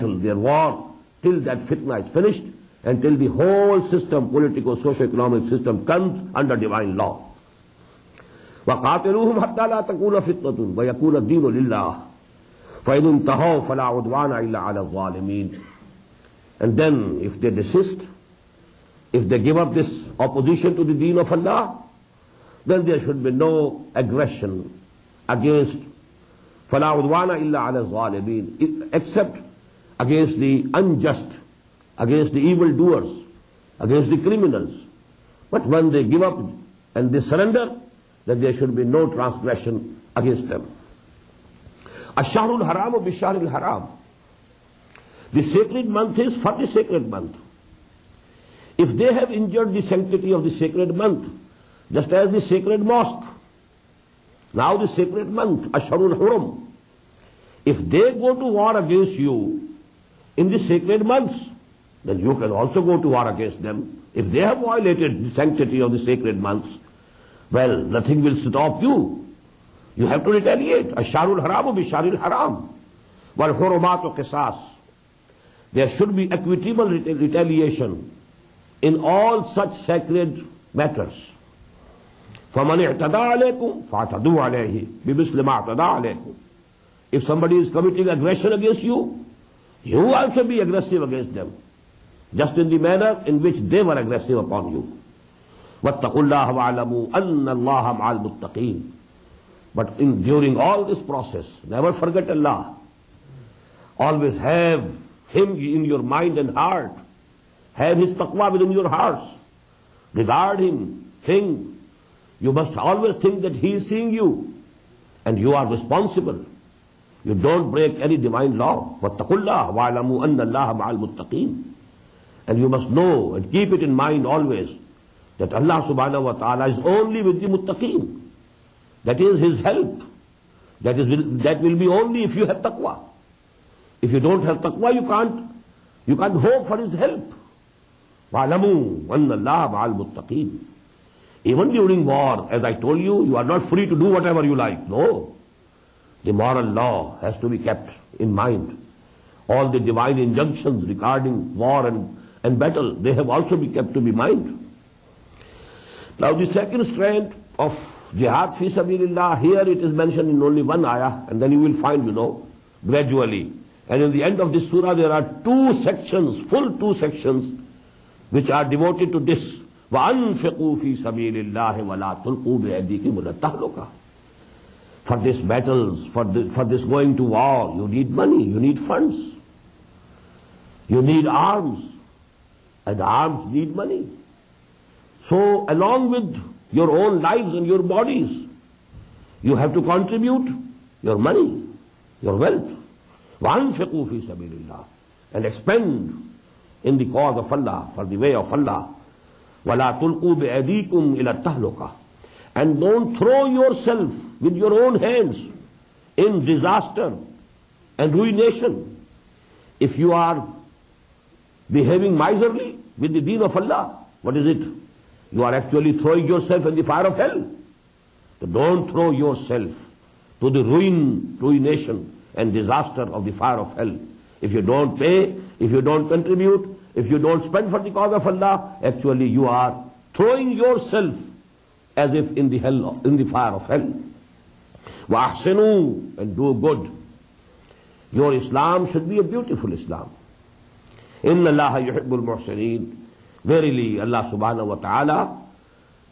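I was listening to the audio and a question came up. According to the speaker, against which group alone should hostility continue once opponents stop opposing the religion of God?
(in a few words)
the evil doers.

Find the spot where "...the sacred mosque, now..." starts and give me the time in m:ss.
0:52.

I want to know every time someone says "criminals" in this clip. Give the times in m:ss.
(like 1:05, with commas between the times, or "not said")
0:34.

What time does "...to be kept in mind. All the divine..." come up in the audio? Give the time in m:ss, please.
2:27.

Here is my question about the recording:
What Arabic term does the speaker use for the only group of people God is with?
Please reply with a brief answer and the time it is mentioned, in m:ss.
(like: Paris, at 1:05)
muttaqeen, at 2:07.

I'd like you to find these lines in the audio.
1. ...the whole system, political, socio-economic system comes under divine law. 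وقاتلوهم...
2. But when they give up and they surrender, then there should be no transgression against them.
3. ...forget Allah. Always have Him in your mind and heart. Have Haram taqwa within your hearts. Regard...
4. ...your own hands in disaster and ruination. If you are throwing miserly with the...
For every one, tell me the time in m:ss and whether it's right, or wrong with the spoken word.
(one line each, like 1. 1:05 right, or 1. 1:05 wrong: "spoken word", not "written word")
1. 0:03 right
2. 0:35 right
3. 1:41 wrong: "His", not "Haram"
4. 3:24 wrong: "behaving", not "throwing".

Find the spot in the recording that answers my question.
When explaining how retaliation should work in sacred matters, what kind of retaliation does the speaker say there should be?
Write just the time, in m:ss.
1:16.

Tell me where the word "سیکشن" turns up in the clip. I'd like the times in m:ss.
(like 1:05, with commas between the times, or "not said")
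2:46.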